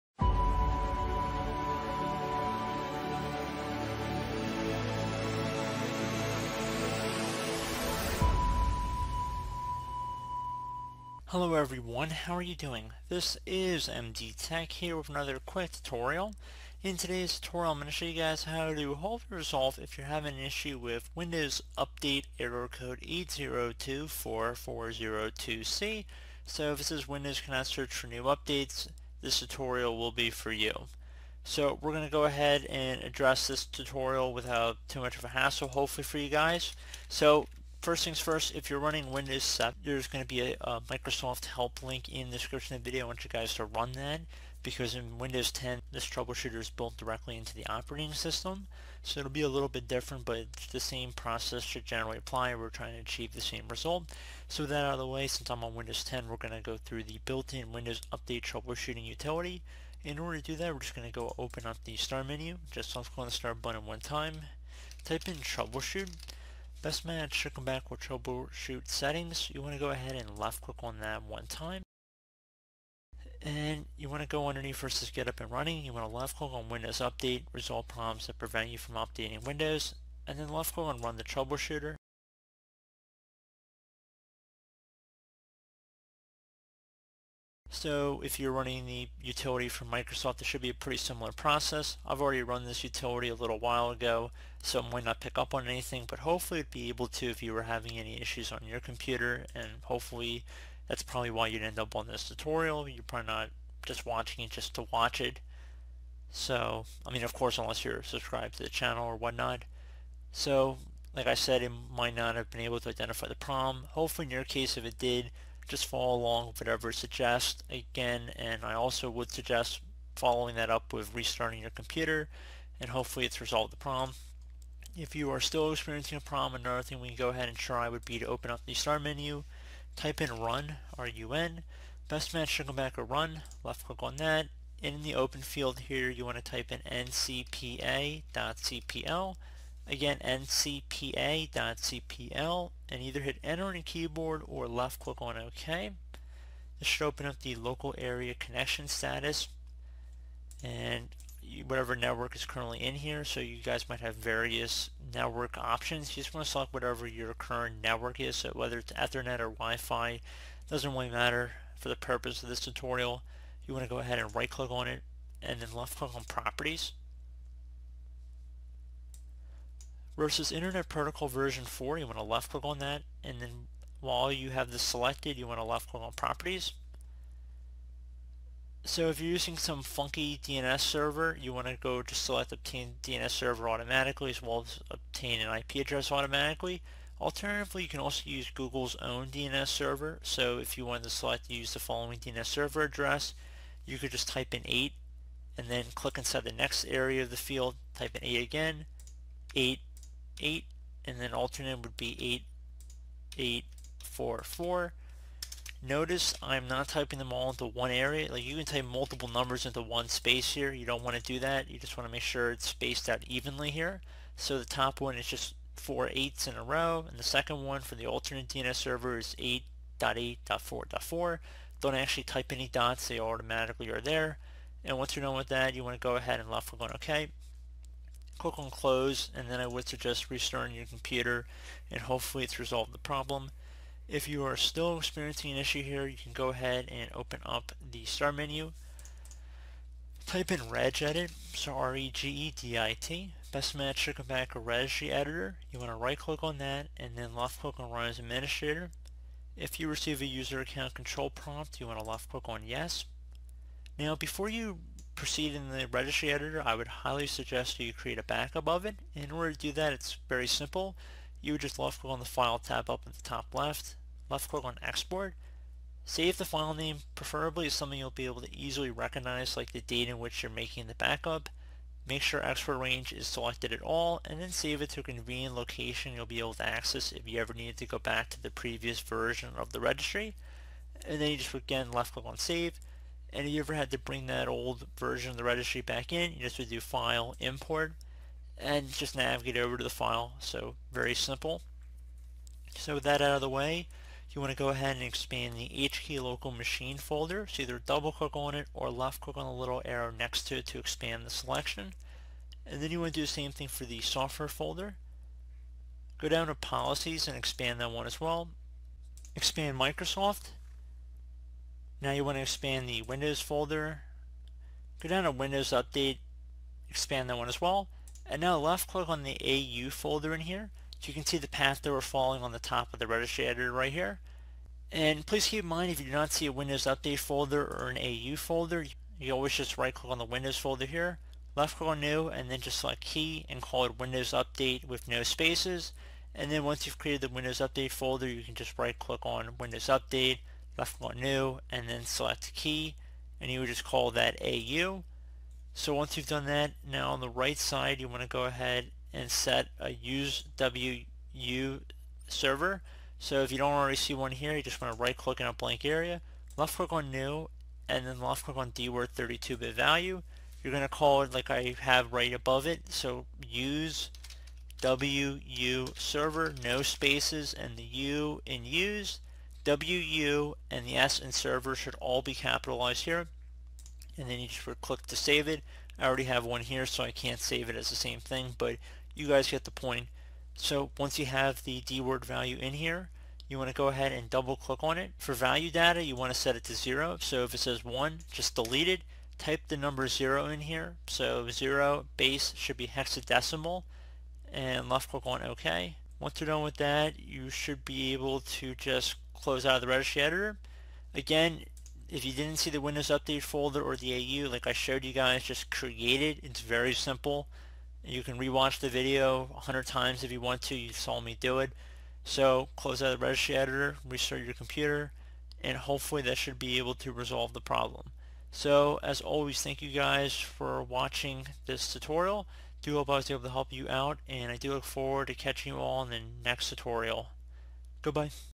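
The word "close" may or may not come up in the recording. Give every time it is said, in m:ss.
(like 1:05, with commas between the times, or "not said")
3:48, 6:39, 6:52.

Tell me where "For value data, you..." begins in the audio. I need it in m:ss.
6:25.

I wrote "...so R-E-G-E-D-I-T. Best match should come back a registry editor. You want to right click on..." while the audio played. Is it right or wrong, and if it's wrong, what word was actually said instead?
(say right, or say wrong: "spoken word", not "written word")
right.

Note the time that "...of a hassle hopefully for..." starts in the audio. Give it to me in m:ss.
0:35.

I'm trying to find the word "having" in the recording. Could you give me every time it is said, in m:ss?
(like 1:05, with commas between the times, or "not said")
0:20, 1:37.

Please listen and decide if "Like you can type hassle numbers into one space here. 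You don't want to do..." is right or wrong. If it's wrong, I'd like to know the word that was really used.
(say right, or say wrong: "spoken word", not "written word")
wrong: "multiple", not "hassle".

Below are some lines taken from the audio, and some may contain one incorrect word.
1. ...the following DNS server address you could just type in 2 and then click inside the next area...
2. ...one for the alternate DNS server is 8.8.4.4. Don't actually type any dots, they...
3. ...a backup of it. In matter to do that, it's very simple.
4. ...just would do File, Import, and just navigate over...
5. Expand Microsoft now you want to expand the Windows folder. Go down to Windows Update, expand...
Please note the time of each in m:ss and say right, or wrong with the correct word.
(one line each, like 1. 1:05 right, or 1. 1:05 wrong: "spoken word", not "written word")
1. 3:11 wrong: "8", not "2"
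2. 3:37 right
3. 4:18 wrong: "order", not "matter"
4. 4:46 right
5. 5:09 right.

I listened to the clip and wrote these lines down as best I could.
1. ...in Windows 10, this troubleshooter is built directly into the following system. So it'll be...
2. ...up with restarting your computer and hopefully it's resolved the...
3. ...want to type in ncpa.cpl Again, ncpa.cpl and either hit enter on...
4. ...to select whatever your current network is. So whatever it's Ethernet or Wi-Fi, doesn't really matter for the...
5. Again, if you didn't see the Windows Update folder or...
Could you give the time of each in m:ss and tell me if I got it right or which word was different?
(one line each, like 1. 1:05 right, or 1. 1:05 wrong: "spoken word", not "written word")
1. 0:44 wrong: "operating", not "following"
2. 2:00 right
3. 2:16 right
4. 2:36 wrong: "whether", not "whatever"
5. 6:41 right.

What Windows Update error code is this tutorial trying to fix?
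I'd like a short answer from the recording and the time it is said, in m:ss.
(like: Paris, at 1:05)
8024402C, at 0:22.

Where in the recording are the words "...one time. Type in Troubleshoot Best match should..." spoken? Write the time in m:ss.
1:03.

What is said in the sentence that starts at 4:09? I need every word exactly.
If you receive a user account control prompt, you want to left click on yes.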